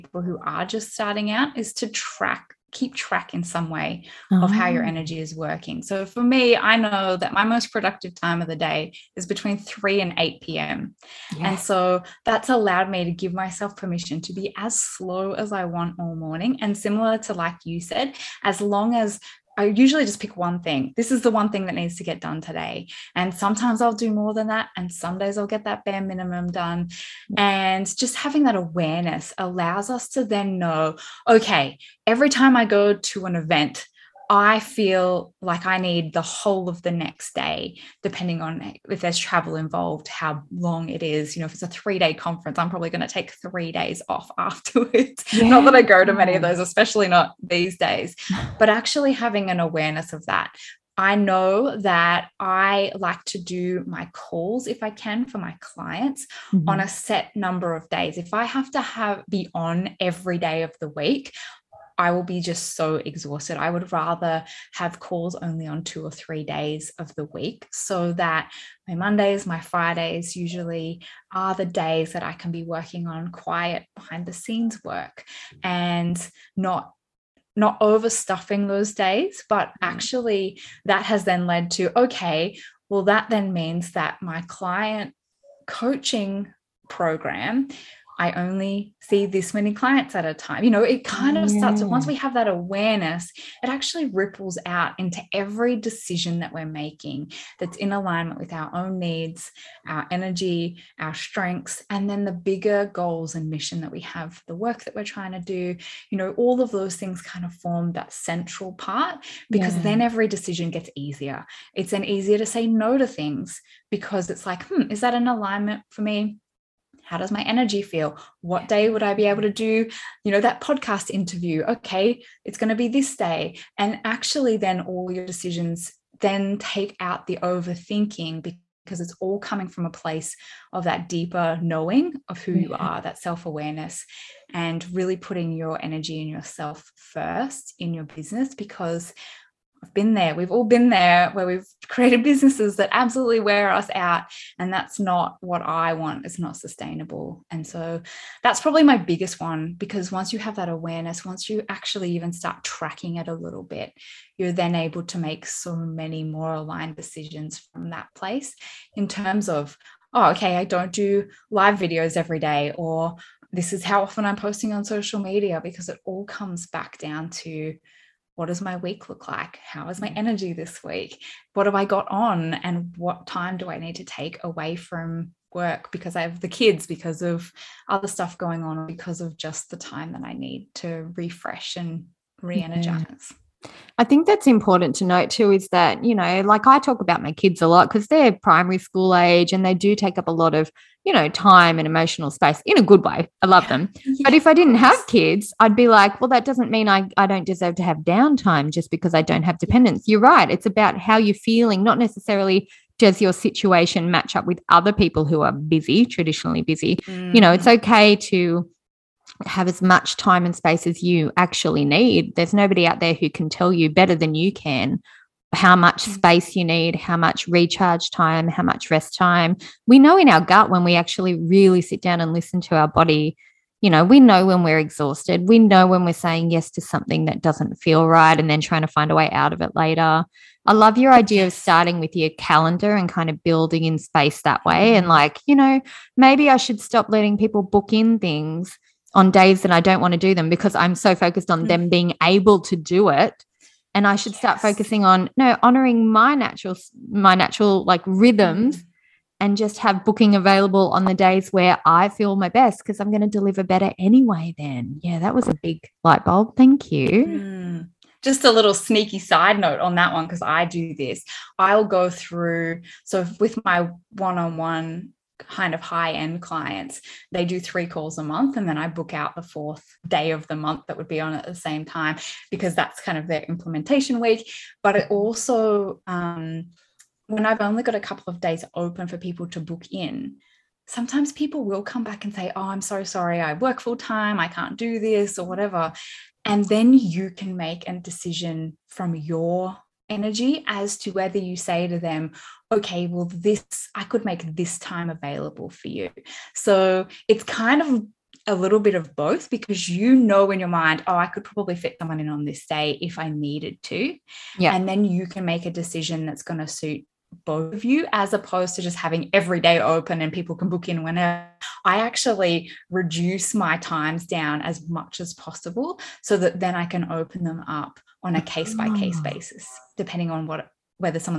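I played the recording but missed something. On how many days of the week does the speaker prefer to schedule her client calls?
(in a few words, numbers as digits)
2 or 3.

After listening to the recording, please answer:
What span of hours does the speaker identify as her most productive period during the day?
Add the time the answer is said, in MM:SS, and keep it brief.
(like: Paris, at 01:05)
3 to 8 p.m., at 00:09.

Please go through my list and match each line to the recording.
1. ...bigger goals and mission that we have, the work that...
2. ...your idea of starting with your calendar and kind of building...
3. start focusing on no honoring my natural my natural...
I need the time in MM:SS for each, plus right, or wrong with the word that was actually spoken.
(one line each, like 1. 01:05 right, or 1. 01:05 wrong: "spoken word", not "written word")
1. 01:42 right
2. 03:50 right
3. 04:04 right.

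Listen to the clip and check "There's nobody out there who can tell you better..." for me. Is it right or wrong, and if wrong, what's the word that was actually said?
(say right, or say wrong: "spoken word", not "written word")
right.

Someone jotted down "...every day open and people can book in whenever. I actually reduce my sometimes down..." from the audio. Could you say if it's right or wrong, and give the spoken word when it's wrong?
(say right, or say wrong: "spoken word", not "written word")
wrong: "times", not "sometimes".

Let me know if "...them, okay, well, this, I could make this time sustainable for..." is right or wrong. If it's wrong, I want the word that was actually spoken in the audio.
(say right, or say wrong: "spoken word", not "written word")
wrong: "available", not "sustainable".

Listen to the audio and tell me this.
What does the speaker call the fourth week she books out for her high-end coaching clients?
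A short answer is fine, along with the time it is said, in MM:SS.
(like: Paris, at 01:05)
implementation week, at 04:33.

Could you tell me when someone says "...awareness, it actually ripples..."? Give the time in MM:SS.
01:32.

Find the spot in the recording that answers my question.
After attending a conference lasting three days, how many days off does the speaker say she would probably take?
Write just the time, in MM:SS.
00:43.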